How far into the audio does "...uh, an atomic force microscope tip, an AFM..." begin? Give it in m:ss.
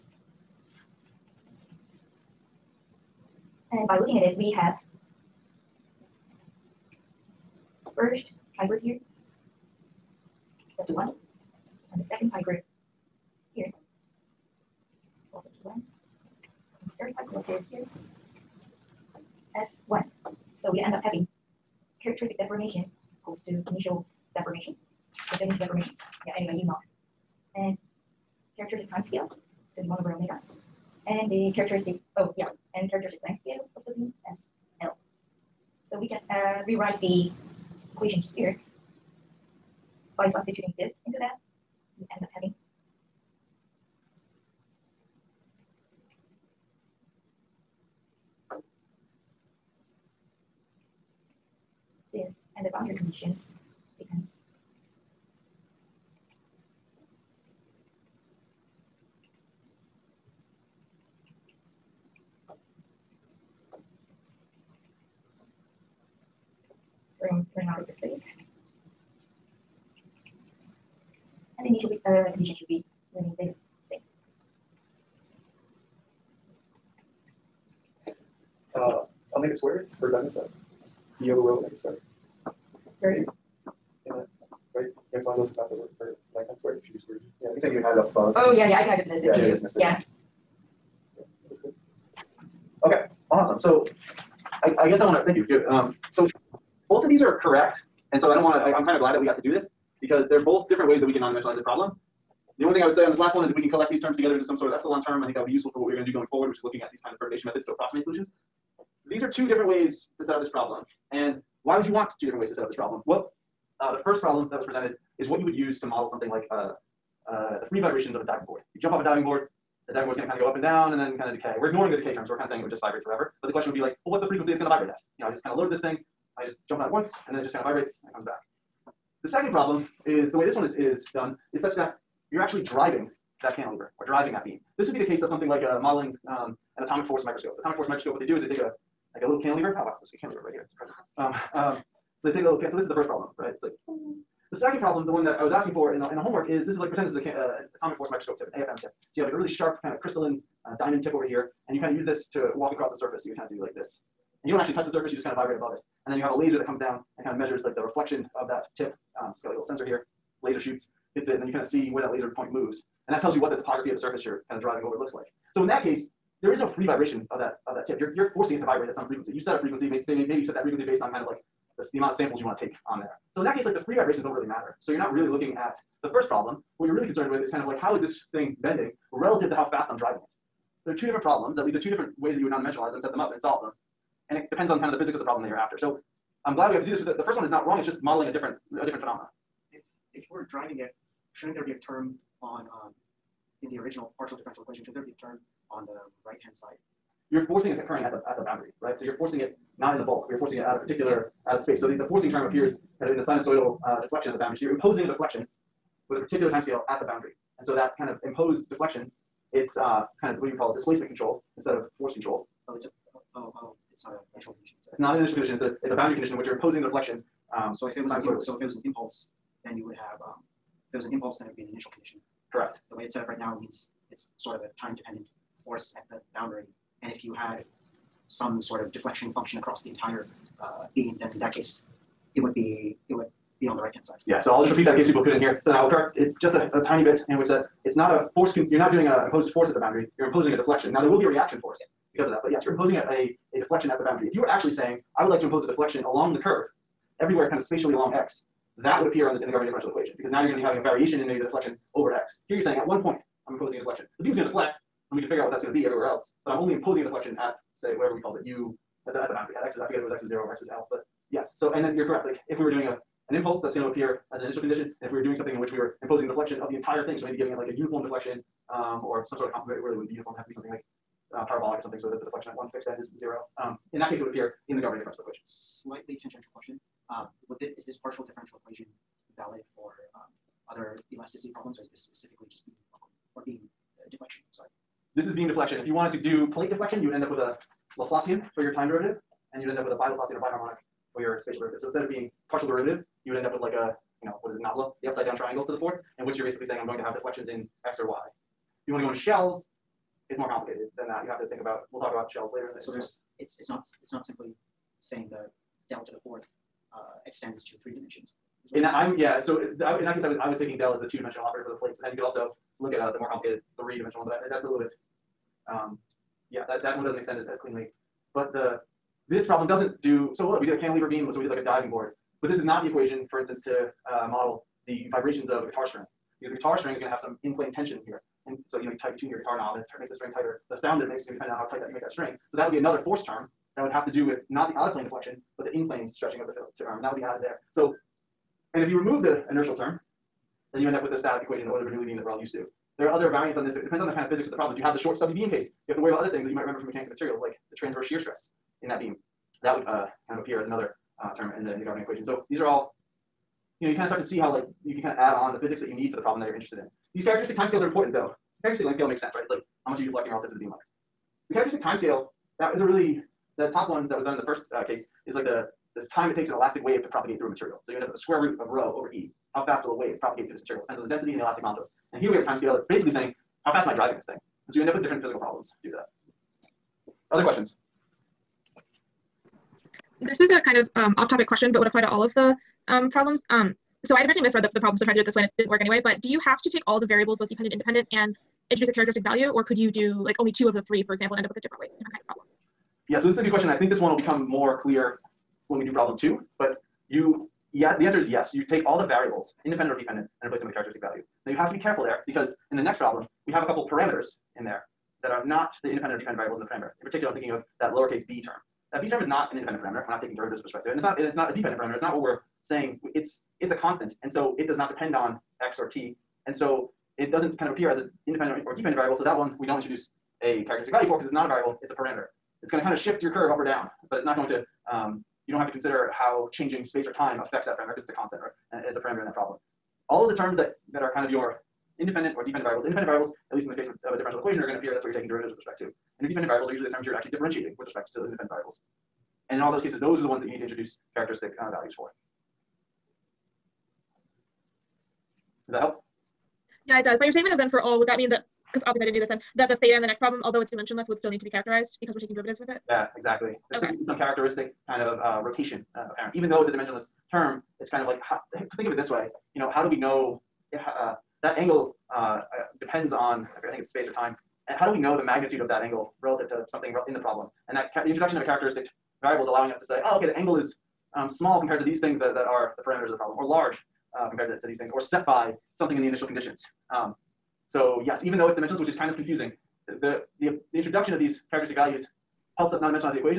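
2:27.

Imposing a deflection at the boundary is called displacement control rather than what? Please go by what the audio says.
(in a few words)
Force control.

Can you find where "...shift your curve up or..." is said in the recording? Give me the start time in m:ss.
7:02.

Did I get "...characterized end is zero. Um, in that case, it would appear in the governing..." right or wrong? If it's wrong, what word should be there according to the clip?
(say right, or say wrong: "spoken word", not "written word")
wrong: "fixed", not "characterized".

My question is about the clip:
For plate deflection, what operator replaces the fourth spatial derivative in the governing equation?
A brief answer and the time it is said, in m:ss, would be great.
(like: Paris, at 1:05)
Bi-Laplacian, at 4:49.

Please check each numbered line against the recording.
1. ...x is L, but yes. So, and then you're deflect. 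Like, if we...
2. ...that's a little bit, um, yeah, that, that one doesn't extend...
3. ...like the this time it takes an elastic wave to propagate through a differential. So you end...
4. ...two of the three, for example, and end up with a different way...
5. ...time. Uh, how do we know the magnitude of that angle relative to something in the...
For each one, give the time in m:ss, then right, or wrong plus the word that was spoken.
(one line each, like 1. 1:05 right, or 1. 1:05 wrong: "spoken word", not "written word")
1. 4:20 wrong: "correct", not "deflect"
2. 5:14 right
3. 6:05 wrong: "material", not "differential"
4. 6:30 right
5. 7:44 right.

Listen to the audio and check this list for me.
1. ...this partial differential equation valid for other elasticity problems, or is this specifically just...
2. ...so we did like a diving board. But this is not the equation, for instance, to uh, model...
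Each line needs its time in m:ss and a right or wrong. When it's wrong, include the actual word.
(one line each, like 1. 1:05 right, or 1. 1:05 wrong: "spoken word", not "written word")
1. 4:37 right
2. 5:21 right.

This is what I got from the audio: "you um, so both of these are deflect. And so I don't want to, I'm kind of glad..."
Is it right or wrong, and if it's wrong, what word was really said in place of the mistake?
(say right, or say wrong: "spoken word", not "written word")
wrong: "correct", not "deflect".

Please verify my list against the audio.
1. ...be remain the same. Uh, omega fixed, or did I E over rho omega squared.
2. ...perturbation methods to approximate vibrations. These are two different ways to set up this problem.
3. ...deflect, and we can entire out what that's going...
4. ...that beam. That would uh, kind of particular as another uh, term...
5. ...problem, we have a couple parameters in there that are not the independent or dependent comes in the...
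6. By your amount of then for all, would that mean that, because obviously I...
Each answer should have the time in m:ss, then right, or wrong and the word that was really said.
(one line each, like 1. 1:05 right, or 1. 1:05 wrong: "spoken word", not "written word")
1. 1:12 wrong: "squared", not "fixed"
2. 1:47 wrong: "solutions", not "vibrations"
3. 4:14 wrong: "figure", not "entire"
4. 5:48 wrong: "appear", not "particular"
5. 6:42 wrong: "variables", not "comes"
6. 7:27 wrong: "statement", not "amount".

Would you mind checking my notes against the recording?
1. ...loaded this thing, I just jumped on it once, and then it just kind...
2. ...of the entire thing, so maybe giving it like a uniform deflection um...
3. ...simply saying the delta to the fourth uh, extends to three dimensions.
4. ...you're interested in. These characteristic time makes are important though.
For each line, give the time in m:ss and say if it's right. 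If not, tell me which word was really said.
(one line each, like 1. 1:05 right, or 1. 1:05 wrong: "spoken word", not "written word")
1. 2:05 right
2. 4:26 right
3. 5:04 right
4. 5:56 wrong: "scales", not "makes".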